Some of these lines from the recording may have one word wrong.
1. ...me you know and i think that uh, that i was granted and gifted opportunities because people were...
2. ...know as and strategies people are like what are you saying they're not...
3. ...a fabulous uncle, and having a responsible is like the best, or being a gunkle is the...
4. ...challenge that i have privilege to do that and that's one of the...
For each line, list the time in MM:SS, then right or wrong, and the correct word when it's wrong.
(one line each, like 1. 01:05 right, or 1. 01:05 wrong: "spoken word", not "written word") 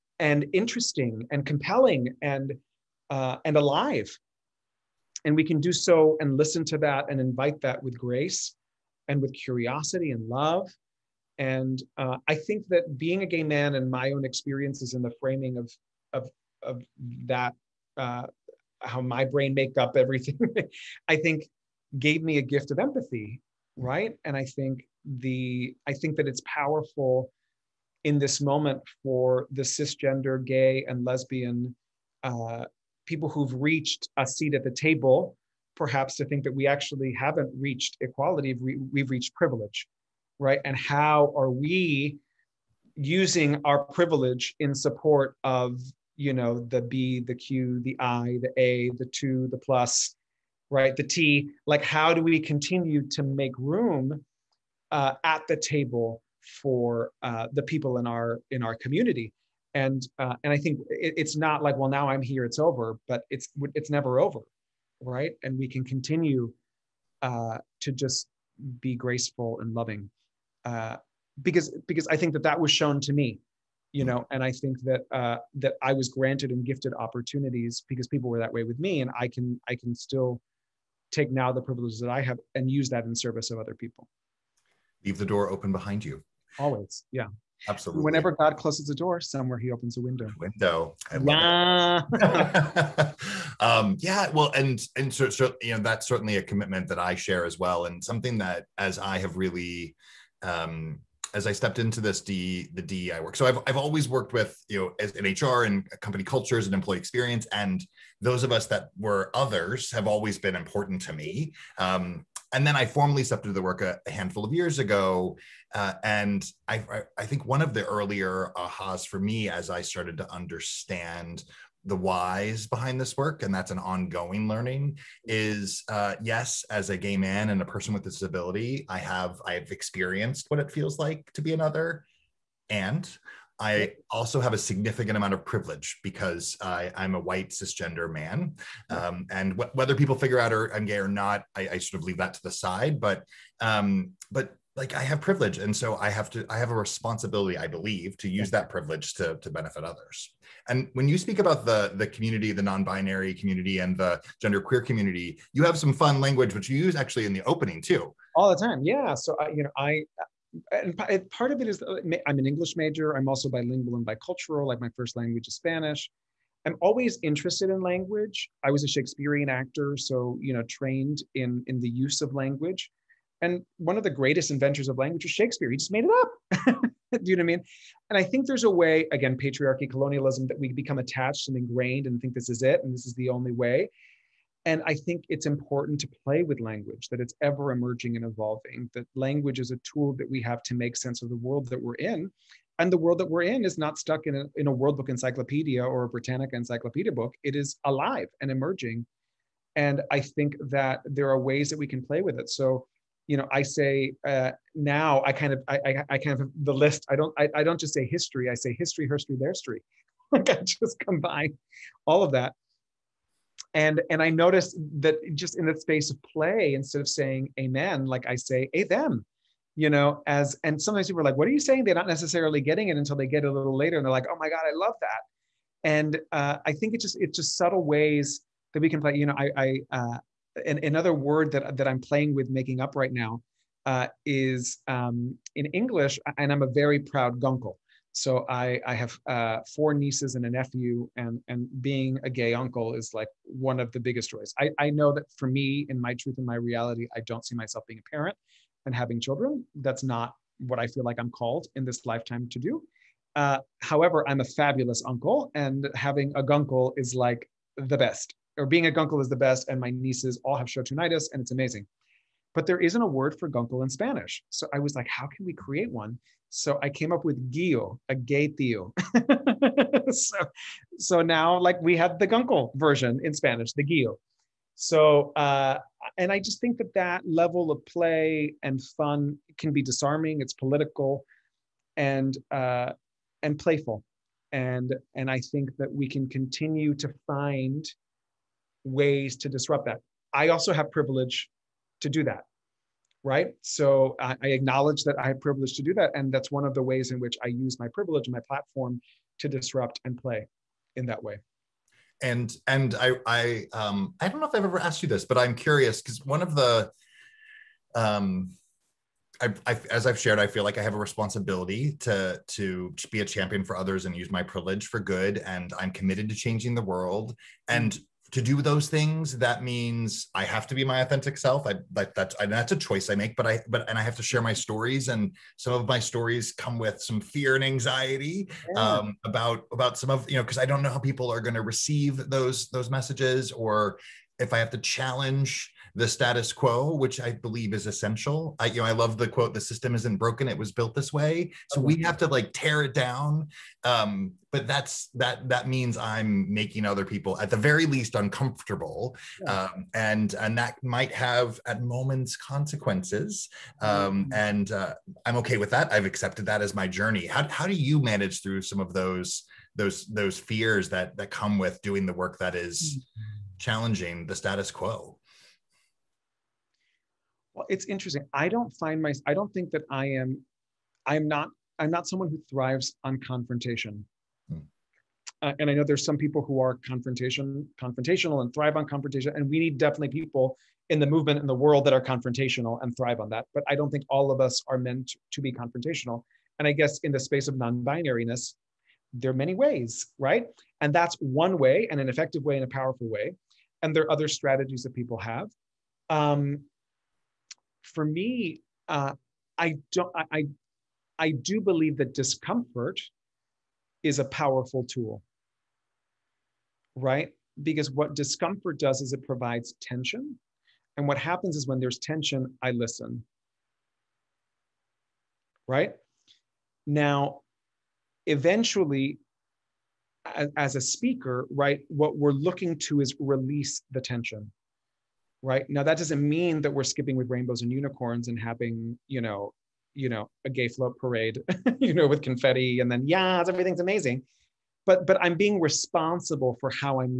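1. 01:13 right
2. 03:39 wrong: "sometimes", not "strategies"
3. 04:14 wrong: "gunkle", not "responsible"
4. 04:54 wrong: "acknowledge", not "challenge".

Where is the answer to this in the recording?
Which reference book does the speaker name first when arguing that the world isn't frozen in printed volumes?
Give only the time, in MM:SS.
03:14.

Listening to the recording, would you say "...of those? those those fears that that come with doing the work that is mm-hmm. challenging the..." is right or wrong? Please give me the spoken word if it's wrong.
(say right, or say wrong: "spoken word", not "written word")
right.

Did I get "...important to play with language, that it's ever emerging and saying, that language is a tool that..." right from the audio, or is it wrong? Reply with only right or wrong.
wrong.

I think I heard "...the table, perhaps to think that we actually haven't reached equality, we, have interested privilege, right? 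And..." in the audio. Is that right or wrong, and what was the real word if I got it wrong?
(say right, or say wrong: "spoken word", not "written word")
wrong: "reached", not "interested".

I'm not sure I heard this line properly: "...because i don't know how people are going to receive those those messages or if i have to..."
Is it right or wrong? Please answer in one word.
right.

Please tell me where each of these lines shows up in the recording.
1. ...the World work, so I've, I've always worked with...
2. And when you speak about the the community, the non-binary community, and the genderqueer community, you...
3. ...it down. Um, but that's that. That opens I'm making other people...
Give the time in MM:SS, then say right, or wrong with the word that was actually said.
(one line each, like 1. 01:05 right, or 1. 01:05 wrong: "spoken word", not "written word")
1. 01:42 wrong: "DEI", not "World"
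2. 02:30 right
3. 05:42 wrong: "means", not "opens".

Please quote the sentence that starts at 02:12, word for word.
And I also have a significant amount of privilege because I, am a white cisgender man.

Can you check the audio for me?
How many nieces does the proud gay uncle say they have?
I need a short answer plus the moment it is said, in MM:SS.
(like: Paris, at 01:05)
4, at 03:59.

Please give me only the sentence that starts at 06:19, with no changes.
And we need definitely people in the movement in the world that are confrontational and thrive on that.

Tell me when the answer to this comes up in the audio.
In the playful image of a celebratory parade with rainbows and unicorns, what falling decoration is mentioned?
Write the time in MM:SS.
07:12.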